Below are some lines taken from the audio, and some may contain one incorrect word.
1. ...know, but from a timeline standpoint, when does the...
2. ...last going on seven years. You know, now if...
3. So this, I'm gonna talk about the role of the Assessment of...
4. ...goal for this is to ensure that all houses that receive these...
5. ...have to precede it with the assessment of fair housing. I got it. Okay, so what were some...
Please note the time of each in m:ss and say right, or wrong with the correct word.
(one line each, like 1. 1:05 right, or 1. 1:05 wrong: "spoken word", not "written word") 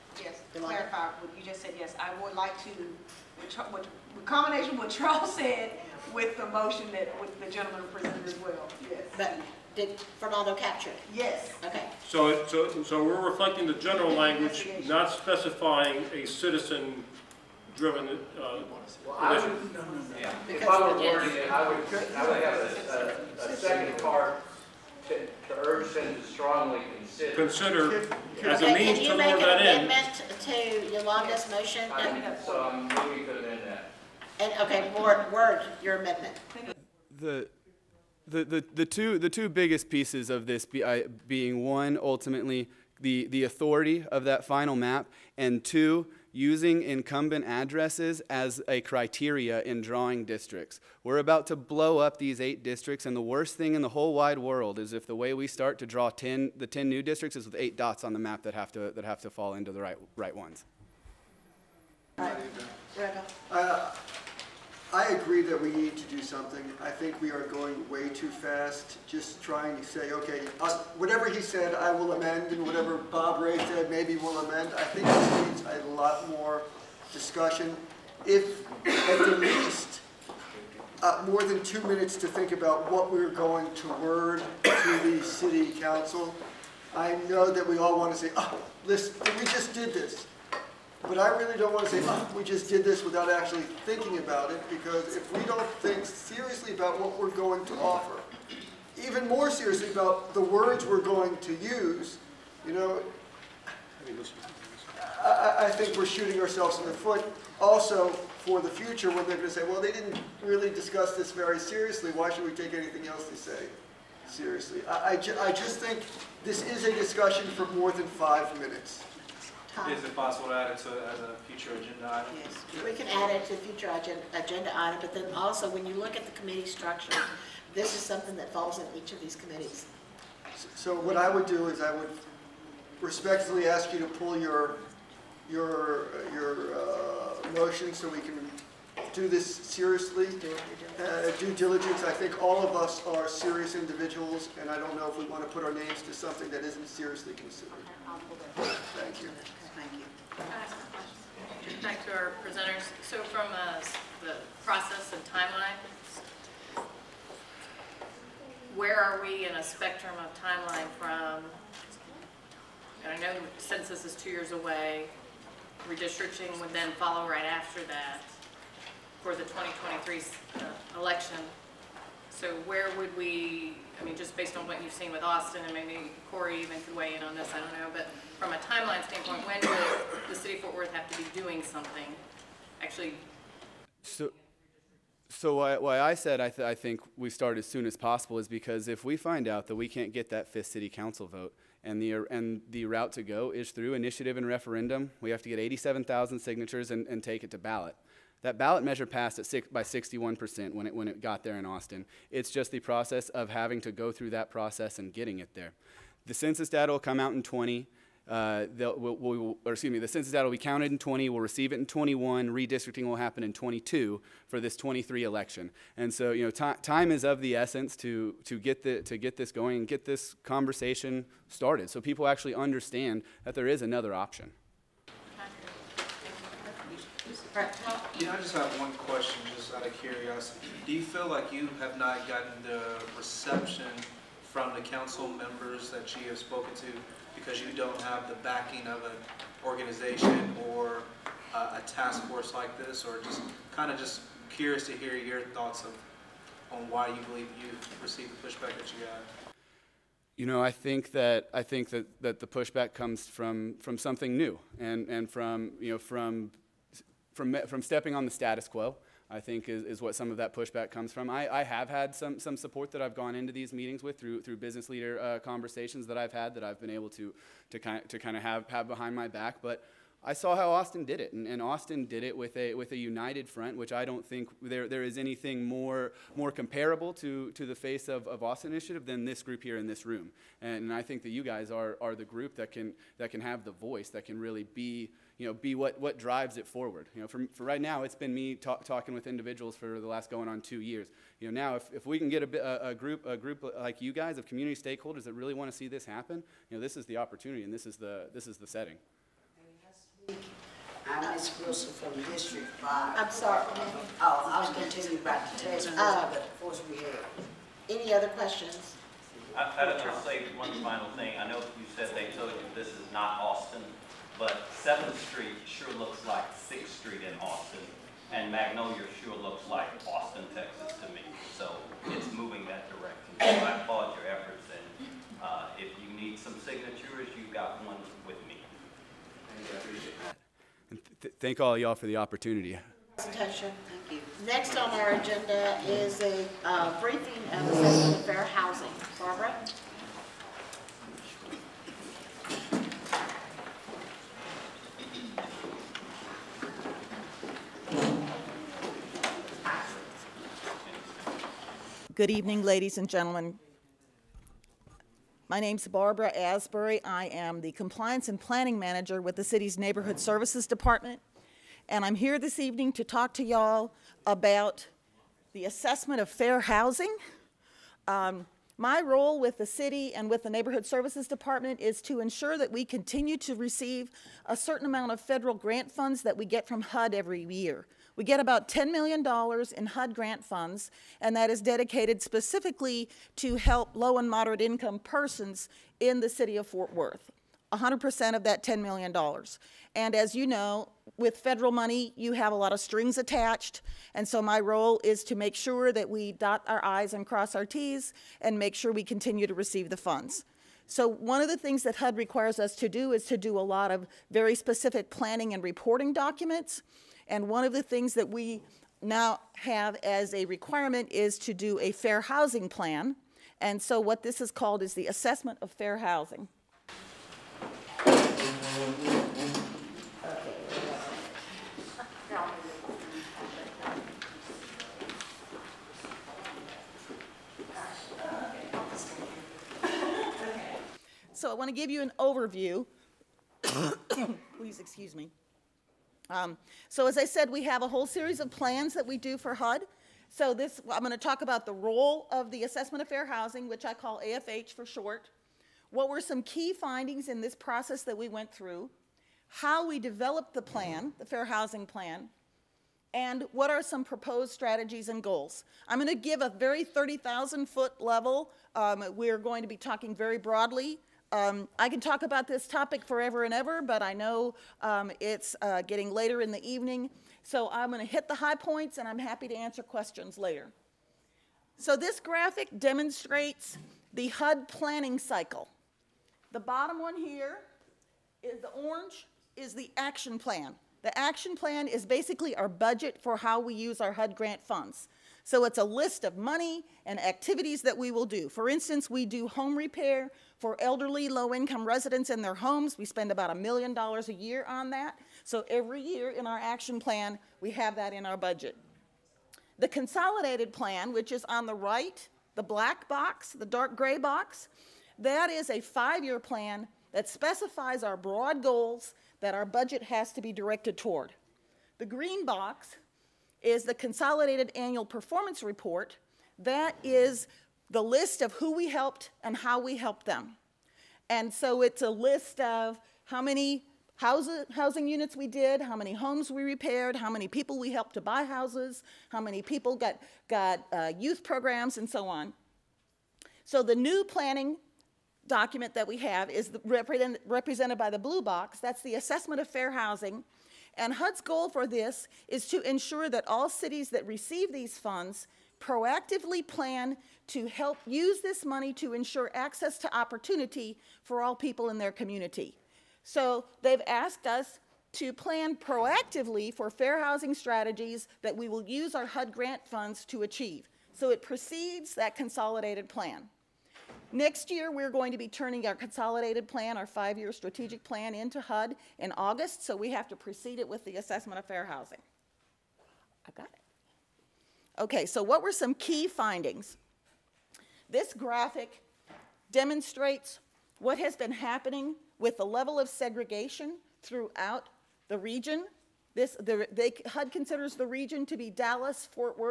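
1. 2:57 right
2. 4:50 wrong: "two", not "seven"
3. 7:20 right
4. 9:01 wrong: "cities", not "houses"
5. 9:30 right.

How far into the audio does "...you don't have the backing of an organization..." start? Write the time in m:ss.
3:57.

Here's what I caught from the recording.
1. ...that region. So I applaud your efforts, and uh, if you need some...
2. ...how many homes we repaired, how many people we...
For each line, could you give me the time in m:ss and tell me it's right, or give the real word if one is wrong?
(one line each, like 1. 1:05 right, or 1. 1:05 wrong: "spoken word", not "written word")
1. 5:22 wrong: "direction", not "region"
2. 8:45 right.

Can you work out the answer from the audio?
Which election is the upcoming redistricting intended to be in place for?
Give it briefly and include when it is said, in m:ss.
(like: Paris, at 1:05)
2023, at 3:34.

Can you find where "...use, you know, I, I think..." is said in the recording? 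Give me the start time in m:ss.
1:41.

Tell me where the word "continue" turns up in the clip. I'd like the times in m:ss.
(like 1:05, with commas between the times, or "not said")
6:12, 6:39.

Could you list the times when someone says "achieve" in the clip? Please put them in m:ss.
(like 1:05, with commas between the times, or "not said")
9:20.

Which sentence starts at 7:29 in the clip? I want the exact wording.
How we developed the plan, the Fair Housing Plan, and what are some proposed strategies and goals?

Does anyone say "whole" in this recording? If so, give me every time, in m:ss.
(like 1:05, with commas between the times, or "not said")
0:53, 7:17.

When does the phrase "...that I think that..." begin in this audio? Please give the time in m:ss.
4:11.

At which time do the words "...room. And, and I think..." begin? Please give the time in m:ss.
4:40.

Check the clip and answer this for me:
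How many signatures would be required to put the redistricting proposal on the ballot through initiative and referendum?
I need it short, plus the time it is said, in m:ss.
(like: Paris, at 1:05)
87,000, at 3:15.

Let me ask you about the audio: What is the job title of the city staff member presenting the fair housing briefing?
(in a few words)
Compliance and Planning Manager.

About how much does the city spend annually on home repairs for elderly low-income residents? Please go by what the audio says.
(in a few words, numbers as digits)
a million dollars.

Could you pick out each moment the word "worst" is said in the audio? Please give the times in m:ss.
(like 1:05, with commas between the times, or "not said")
0:53.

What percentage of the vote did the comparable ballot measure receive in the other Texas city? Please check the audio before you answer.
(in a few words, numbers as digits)
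61%.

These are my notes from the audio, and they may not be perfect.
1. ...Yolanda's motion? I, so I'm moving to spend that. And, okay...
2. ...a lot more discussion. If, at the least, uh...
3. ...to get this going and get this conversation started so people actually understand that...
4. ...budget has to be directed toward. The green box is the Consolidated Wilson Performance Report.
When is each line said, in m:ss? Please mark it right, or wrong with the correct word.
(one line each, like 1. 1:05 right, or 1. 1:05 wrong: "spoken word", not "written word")
1. 0:30 wrong: "amend", not "spend"
2. 1:15 right
3. 3:39 right
4. 8:29 wrong: "Annual", not "Wilson".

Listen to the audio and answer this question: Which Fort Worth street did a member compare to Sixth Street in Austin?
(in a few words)
7th Street.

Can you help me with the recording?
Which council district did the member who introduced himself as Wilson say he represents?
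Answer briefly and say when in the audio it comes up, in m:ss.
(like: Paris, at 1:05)
District 5, at 5:02.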